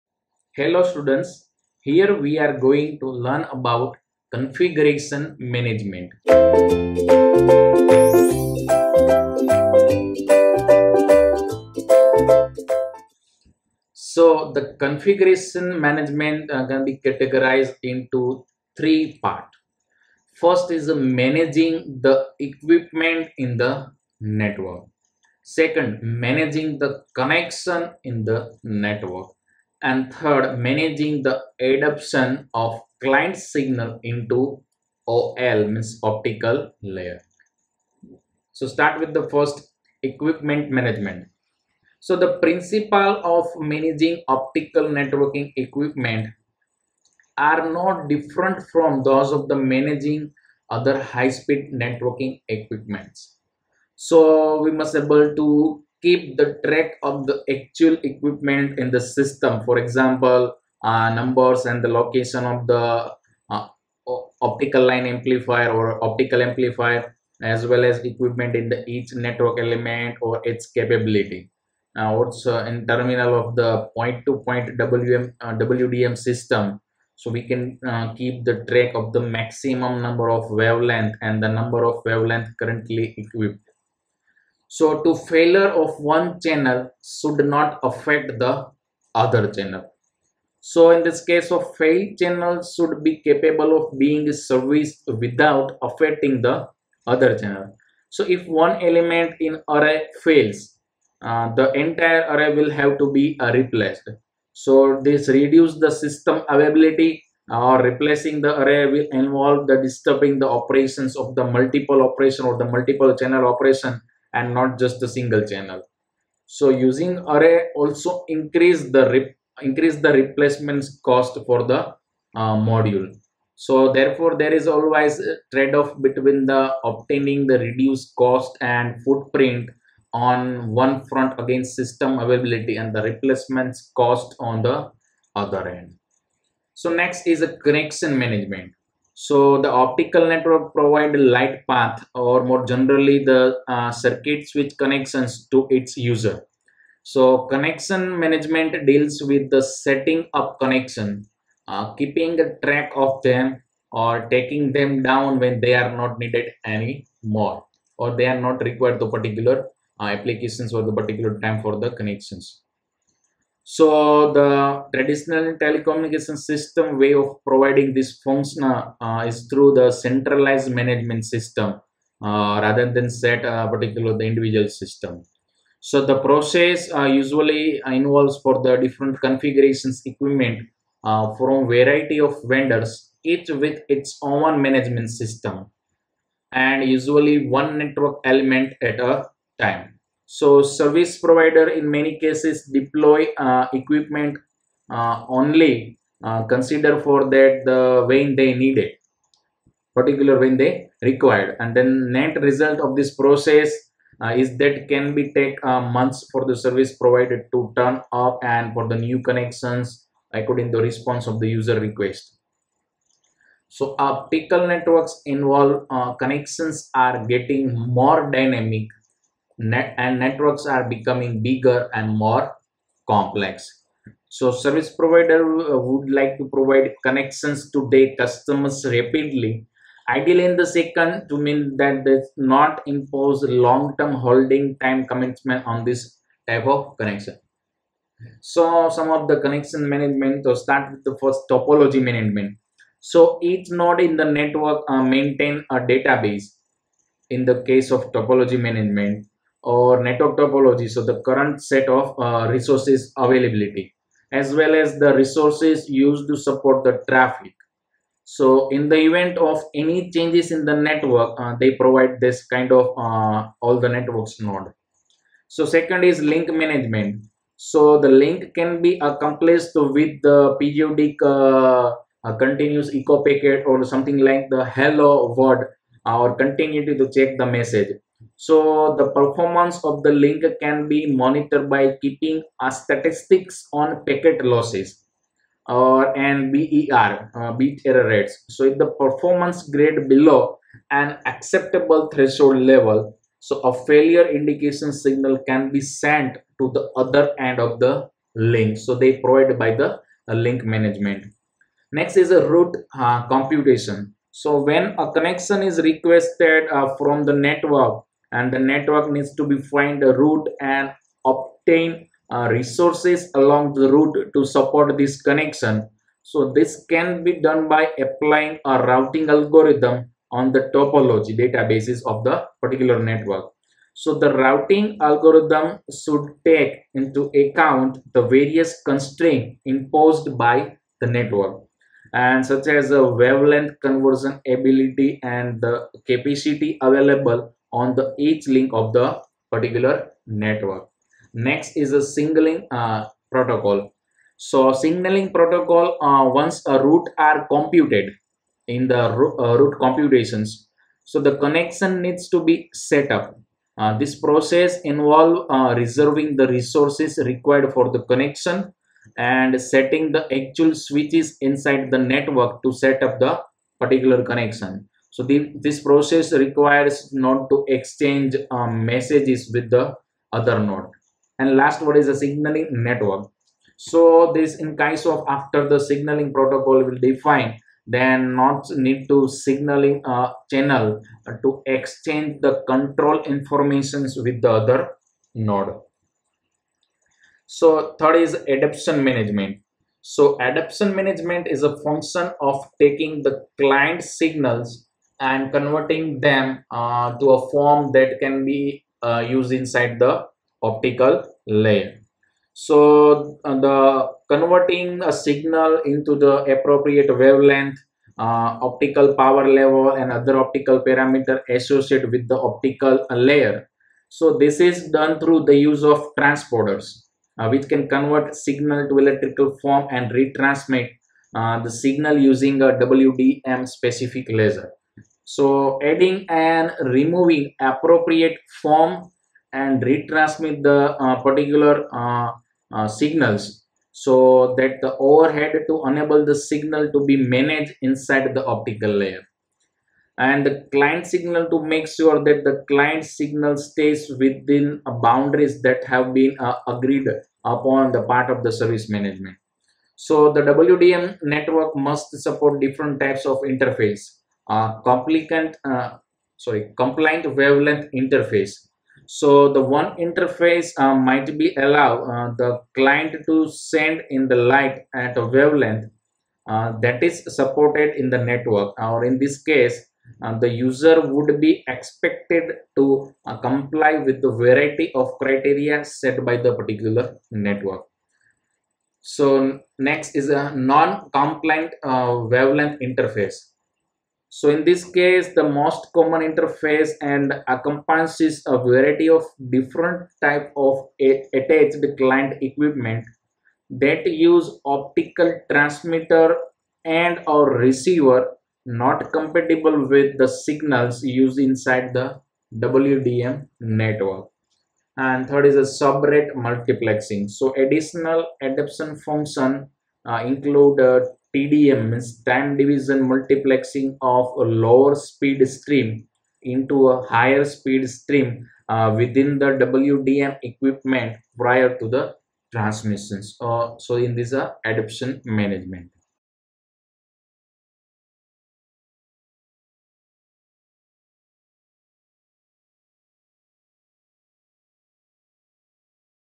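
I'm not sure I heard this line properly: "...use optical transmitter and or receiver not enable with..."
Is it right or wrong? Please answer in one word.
wrong.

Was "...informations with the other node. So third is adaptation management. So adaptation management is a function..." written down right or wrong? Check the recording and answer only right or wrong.
right.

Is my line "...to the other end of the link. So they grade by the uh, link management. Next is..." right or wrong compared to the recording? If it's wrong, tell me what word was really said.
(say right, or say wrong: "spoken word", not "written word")
wrong: "provide", not "grade".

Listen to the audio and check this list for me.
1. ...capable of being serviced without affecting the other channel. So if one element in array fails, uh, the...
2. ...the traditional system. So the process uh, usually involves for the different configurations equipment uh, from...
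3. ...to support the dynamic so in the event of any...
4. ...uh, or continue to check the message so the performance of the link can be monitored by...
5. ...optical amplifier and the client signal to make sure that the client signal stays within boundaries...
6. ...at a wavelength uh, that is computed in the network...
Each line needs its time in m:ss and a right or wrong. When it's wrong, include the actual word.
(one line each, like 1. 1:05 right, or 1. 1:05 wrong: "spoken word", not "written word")
1. 1:33 right
2. 2:54 wrong: "individual", not "traditional"
3. 4:16 wrong: "traffic", not "dynamic"
4. 4:36 right
5. 7:18 wrong: "layer", not "amplifier"
6. 7:44 wrong: "supported", not "computed".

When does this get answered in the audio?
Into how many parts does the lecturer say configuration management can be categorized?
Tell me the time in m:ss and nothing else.
0:18.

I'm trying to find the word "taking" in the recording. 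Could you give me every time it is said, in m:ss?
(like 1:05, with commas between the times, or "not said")
2:34, 6:32.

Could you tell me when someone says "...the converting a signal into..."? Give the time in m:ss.
6:43.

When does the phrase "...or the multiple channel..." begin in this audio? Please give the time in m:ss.
1:52.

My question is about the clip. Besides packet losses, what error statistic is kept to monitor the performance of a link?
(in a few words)
BER.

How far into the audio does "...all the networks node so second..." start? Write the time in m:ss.
4:23.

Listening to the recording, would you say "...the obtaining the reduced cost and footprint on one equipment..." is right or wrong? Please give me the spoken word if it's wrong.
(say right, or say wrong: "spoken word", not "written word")
wrong: "front", not "equipment".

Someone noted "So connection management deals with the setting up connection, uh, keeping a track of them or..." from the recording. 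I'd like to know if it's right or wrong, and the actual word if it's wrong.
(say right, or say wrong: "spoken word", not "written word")
right.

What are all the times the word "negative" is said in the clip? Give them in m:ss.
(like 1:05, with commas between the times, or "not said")
not said.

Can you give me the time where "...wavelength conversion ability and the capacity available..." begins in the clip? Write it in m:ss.
5:33.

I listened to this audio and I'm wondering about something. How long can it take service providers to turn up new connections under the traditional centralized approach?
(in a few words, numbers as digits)
Months.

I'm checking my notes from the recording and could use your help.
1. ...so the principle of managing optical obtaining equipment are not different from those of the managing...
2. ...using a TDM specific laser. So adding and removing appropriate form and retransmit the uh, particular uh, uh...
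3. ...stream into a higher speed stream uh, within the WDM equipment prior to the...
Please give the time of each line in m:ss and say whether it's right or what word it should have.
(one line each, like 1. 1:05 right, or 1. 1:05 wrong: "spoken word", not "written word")
1. 0:41 wrong: "networking", not "obtaining"
2. 7:02 wrong: "WDM", not "TDM"
3. 8:35 right.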